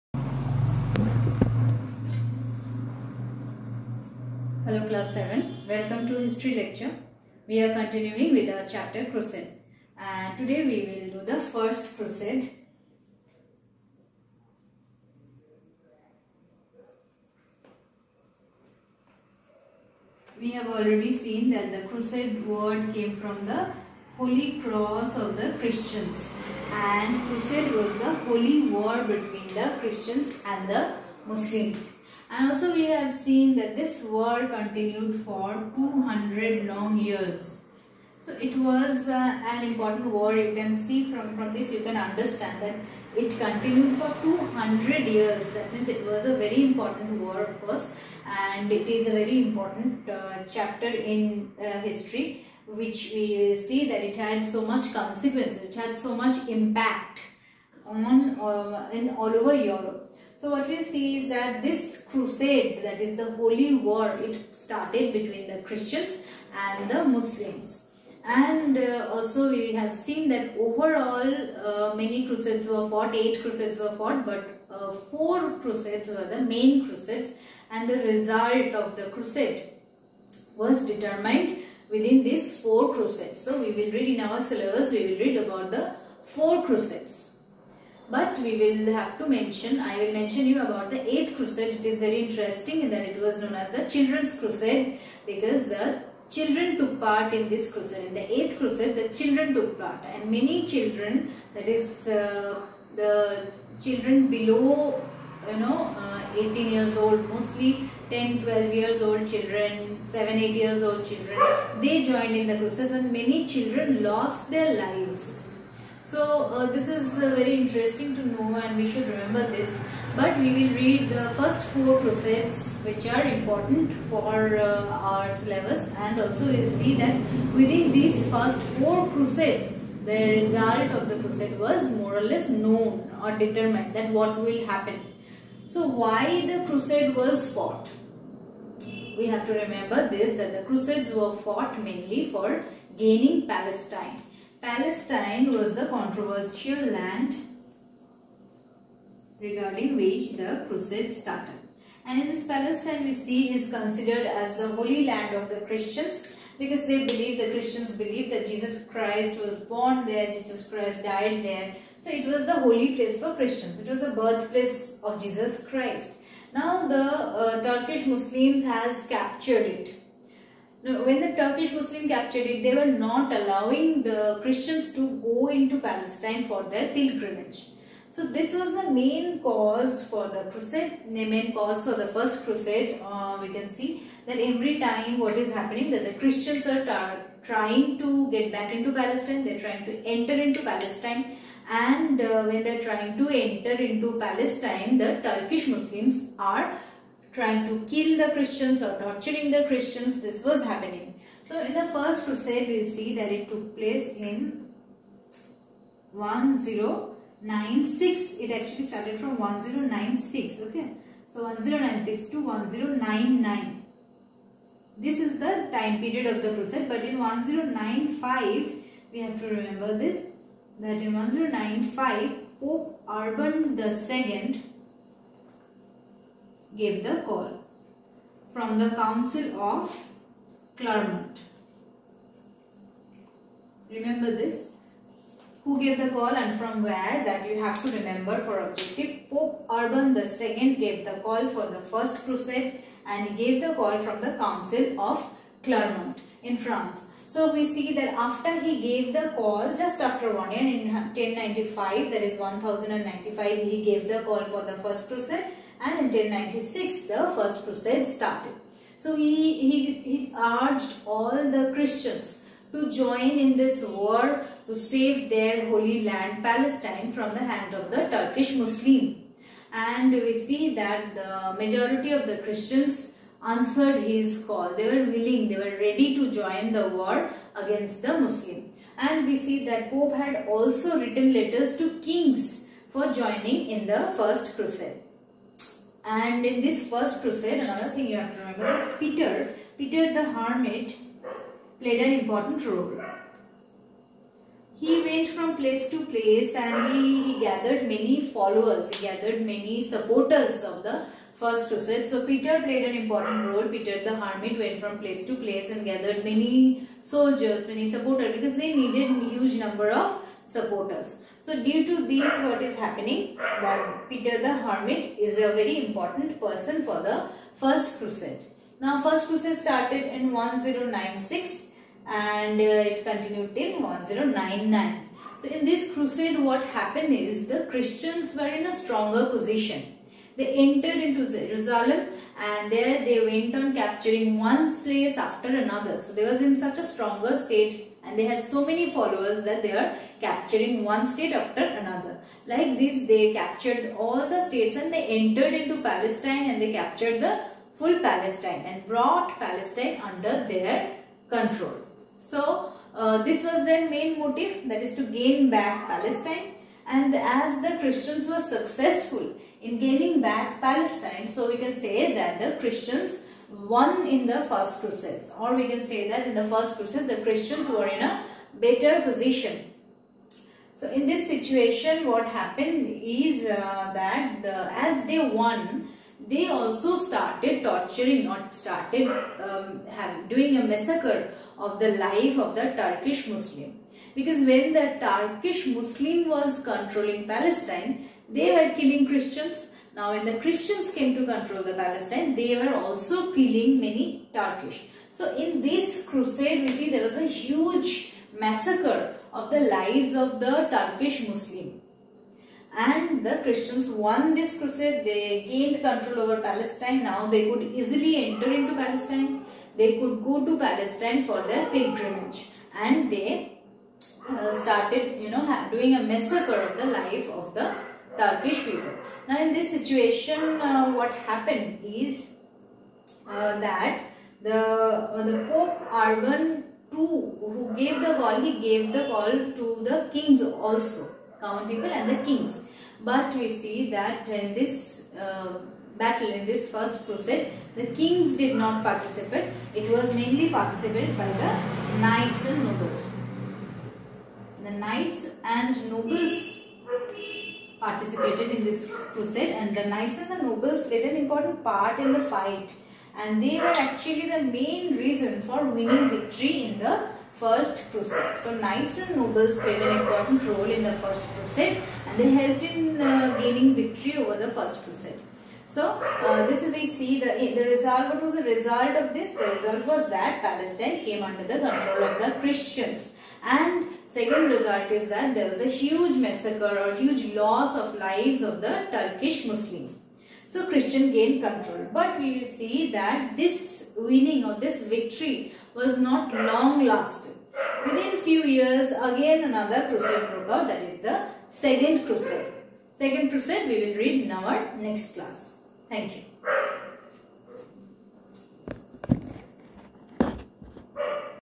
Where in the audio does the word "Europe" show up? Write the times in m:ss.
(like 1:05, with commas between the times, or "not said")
0:59.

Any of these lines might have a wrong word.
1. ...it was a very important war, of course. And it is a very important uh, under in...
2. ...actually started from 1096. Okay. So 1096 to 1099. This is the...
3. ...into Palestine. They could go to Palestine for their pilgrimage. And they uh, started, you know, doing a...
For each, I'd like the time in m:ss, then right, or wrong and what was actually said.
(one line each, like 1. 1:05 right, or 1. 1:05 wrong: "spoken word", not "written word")
1. 0:45 wrong: "chapter", not "under"
2. 3:28 right
3. 6:48 right.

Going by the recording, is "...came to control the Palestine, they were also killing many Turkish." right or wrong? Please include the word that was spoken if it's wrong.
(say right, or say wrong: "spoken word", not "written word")
right.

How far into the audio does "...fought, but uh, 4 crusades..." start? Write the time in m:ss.
1:13.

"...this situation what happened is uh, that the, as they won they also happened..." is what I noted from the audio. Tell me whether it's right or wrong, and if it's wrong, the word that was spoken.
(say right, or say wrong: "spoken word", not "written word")
wrong: "started", not "happened".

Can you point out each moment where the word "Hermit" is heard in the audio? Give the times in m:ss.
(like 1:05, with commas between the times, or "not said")
4:50, 5:04, 5:14.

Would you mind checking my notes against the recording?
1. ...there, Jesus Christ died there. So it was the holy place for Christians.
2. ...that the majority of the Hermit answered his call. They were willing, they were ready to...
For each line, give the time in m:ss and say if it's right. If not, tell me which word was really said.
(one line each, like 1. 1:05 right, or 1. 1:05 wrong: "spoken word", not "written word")
1. 2:40 right
2. 4:30 wrong: "Christians", not "Hermit".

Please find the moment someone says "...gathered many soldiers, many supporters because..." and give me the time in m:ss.
5:05.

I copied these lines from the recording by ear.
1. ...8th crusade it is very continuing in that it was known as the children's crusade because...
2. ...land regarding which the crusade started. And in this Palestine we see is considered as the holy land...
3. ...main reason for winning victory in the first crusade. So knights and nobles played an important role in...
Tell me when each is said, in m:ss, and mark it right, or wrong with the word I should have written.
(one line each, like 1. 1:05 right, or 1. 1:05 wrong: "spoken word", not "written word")
1. 1:31 wrong: "interesting", not "continuing"
2. 2:26 right
3. 7:34 right.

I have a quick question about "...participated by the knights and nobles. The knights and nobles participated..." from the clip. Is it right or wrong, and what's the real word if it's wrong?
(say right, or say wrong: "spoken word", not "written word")
right.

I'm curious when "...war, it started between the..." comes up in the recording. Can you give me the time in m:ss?
1:03.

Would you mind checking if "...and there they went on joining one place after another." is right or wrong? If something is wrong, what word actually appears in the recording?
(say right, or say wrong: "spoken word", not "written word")
wrong: "capturing", not "joining".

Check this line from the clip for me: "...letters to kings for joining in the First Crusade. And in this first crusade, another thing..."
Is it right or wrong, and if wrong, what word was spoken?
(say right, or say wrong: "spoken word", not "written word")
right.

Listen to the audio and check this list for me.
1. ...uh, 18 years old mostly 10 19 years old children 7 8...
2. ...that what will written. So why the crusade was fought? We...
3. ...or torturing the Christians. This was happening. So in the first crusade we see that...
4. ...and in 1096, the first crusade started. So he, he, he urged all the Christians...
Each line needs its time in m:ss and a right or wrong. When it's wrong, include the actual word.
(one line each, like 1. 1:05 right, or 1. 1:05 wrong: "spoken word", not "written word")
1. 1:46 wrong: "12", not "19"
2. 2:13 wrong: "happen", not "written"
3. 3:18 right
4. 4:15 right.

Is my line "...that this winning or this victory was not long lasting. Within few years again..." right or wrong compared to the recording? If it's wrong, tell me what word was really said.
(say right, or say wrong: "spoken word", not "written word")
right.